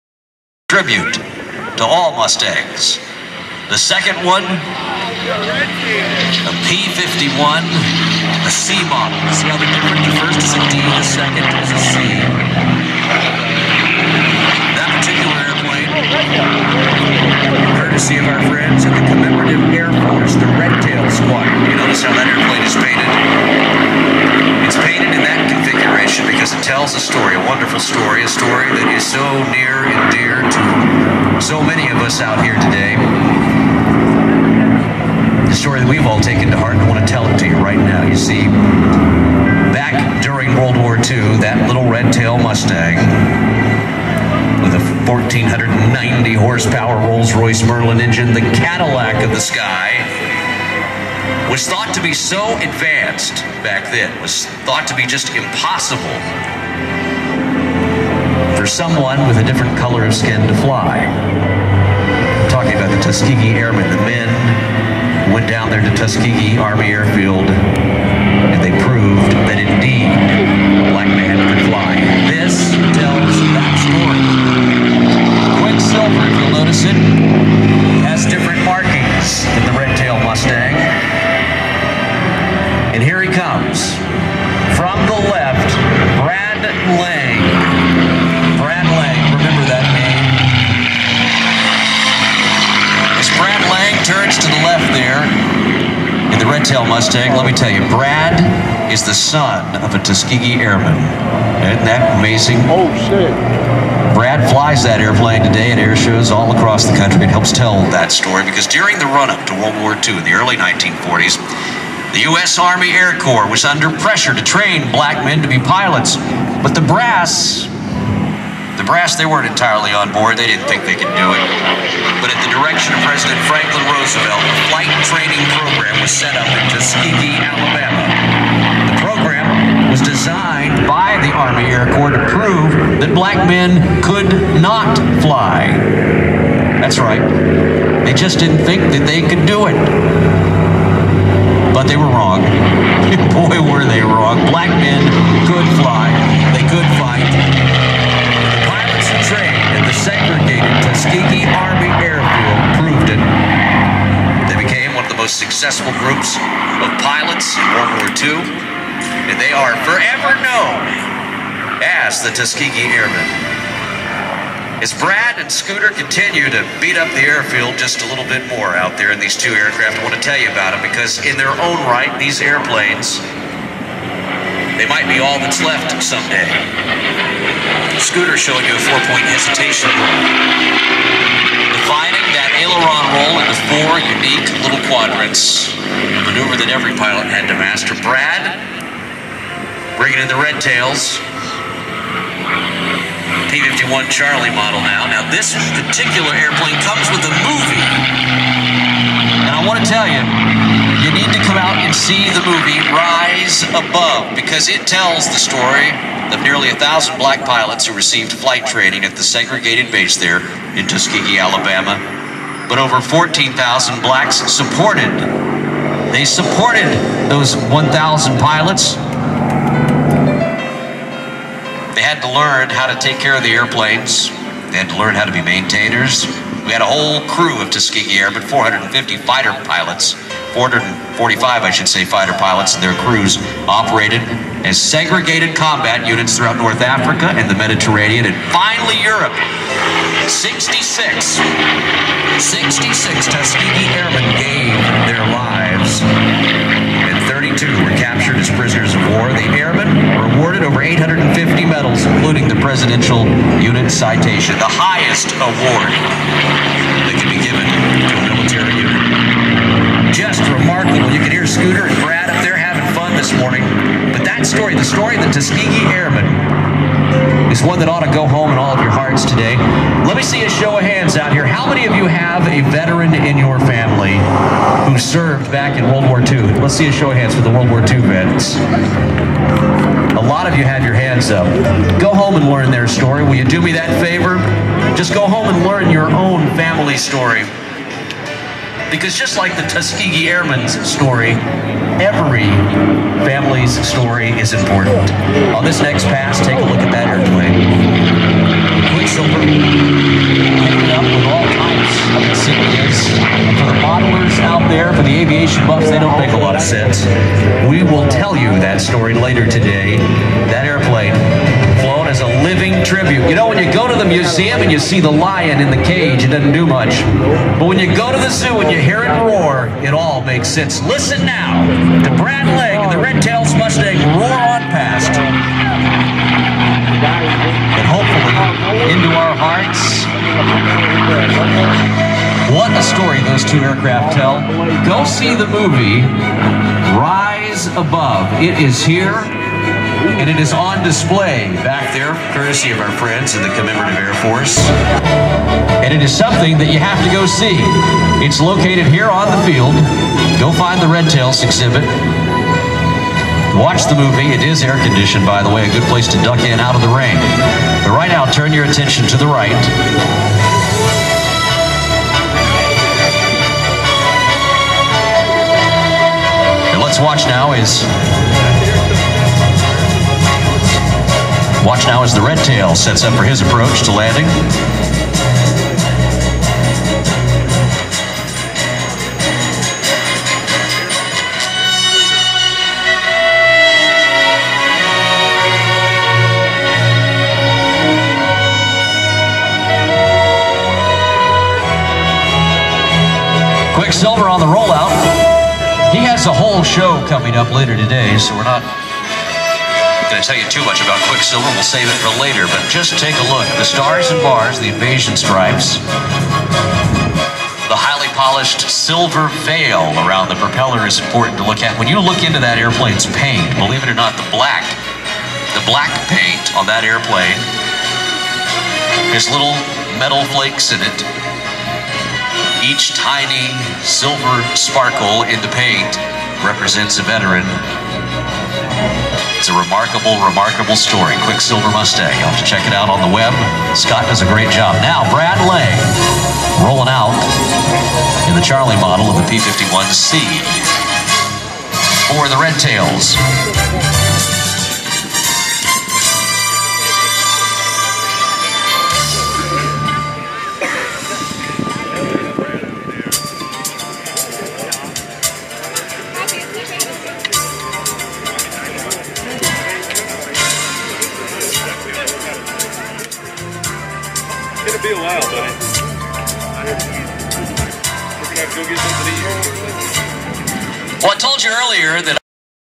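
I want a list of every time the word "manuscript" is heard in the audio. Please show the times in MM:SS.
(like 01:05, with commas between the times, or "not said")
not said.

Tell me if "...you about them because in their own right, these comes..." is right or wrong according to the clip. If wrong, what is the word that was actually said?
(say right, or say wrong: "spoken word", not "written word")
wrong: "airplanes", not "comes".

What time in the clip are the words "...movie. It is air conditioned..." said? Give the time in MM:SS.
05:53.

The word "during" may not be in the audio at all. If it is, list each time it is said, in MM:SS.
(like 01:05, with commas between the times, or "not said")
00:40, 01:48.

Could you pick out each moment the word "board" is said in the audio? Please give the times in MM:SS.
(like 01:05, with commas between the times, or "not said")
02:00.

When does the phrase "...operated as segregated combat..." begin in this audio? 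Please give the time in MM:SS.
03:53.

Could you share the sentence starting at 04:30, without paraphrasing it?
Let me see a show of hands out here.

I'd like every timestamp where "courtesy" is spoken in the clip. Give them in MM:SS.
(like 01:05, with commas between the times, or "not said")
00:17, 05:42.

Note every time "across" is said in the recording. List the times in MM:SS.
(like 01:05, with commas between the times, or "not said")
01:46.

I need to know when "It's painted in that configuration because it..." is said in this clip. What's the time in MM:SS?
00:24.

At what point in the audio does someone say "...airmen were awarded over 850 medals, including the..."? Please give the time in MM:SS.
04:09.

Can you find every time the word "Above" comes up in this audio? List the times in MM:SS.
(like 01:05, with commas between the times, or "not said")
03:23, 05:37.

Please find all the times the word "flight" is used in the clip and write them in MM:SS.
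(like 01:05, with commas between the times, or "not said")
02:04, 03:28.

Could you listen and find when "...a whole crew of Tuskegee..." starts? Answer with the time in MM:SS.
03:46.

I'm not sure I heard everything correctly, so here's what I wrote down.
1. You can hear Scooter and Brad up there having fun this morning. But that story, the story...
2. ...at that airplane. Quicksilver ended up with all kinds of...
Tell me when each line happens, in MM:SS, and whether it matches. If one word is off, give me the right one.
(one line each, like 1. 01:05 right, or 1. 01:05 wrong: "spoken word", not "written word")
1. 04:21 right
2. 04:56 right.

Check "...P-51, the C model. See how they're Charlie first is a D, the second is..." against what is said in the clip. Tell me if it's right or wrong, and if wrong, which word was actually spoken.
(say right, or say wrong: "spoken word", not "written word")
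wrong: "The", not "Charlie".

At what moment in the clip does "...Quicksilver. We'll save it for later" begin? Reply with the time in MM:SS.
06:41.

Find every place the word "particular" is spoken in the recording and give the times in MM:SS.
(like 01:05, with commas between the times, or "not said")
00:14, 03:15.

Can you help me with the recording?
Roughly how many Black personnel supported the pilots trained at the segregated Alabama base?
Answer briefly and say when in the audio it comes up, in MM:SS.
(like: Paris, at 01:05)
14,000, at 03:33.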